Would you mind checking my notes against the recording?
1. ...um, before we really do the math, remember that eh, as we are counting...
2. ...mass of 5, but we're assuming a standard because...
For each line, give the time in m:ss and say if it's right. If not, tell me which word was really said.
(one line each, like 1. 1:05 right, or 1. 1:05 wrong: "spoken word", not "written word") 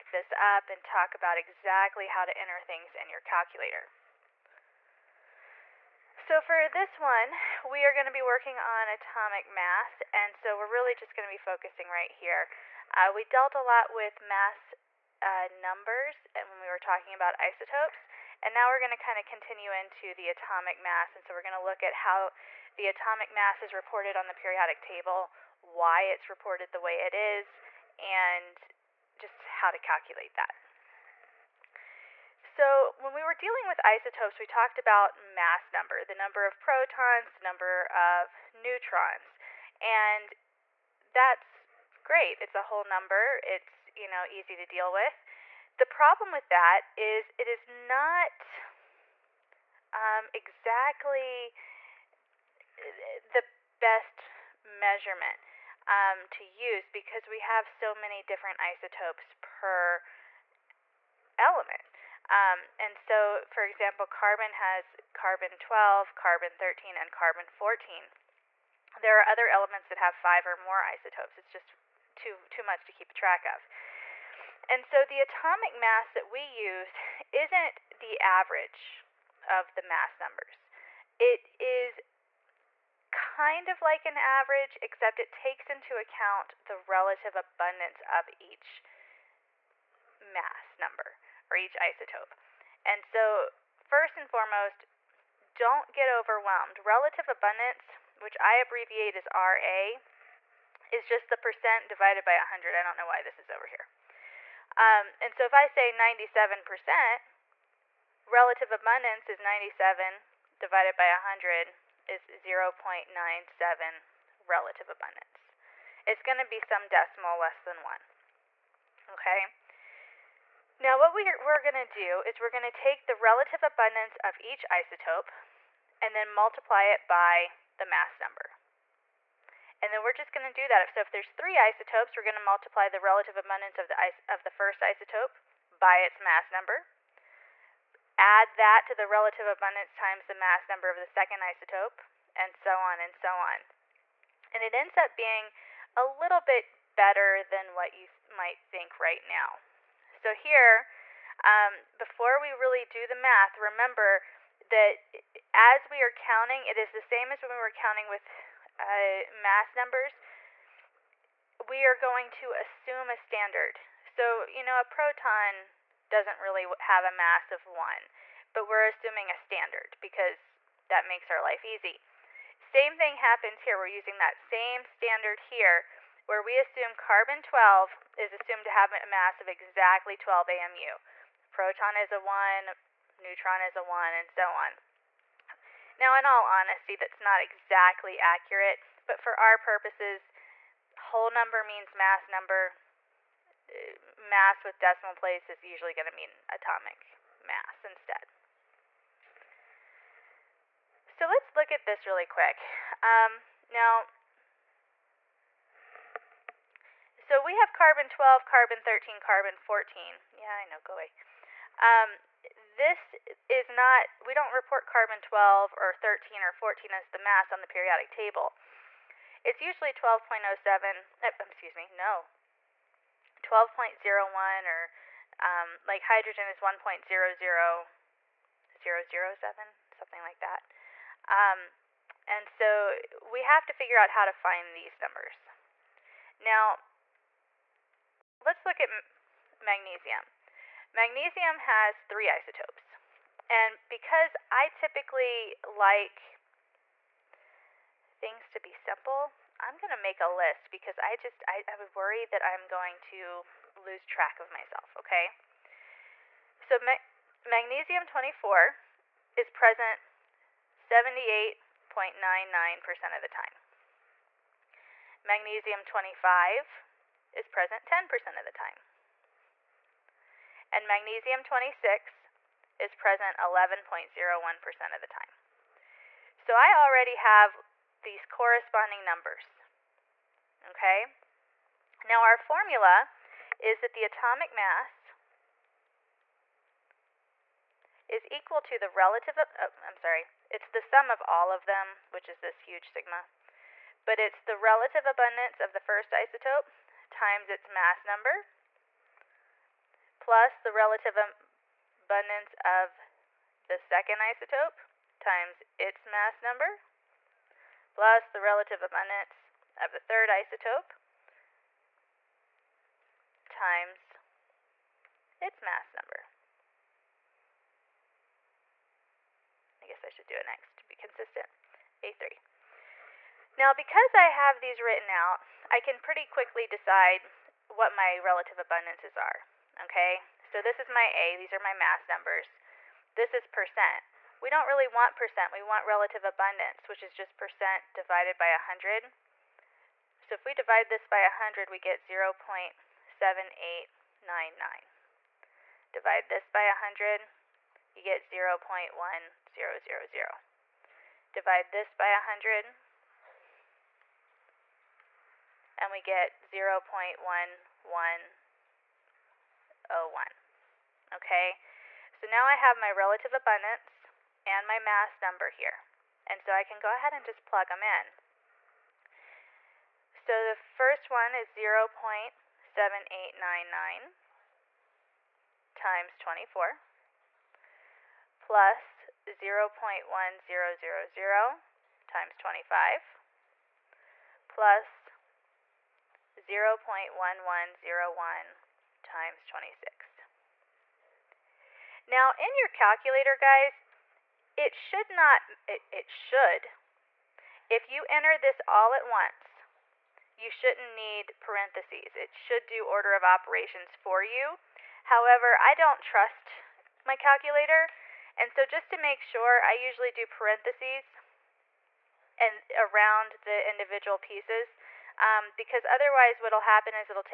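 1. 2:31 right
2. 2:47 wrong: "1", not "5".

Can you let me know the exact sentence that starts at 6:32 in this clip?
Now in your calculator guys, it should not, it, it should, if you enter this all at once, you shouldn't need parentheses.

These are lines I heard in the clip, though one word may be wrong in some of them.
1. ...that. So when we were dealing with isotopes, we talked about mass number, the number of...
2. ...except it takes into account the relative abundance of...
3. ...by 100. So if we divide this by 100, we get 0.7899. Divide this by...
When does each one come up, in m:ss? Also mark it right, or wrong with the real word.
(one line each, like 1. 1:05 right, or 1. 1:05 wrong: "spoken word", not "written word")
1. 0:30 right
2. 1:24 right
3. 5:38 right.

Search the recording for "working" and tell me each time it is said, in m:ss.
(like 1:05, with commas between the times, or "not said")
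0:08.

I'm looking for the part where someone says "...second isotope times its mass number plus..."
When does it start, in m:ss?
5:03.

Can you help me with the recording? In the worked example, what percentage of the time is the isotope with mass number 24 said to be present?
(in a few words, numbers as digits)
78.99%.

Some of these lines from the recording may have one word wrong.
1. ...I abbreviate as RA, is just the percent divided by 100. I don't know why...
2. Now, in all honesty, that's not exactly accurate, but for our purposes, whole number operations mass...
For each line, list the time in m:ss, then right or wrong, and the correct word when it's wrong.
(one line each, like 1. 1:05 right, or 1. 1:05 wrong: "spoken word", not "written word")
1. 1:38 right
2. 3:05 wrong: "means", not "operations".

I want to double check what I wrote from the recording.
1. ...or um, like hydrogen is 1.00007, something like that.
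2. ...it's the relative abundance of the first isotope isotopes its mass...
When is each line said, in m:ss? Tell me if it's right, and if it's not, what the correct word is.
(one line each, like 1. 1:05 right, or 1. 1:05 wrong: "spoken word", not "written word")
1. 3:44 right
2. 4:54 wrong: "times", not "isotopes".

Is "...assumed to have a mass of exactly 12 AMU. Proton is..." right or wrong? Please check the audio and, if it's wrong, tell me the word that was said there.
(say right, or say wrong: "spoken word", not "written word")
right.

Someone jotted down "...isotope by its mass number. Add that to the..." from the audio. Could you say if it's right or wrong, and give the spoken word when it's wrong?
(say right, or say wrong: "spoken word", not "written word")
right.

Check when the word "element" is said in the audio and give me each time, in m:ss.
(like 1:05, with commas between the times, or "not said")
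1:01, 1:09.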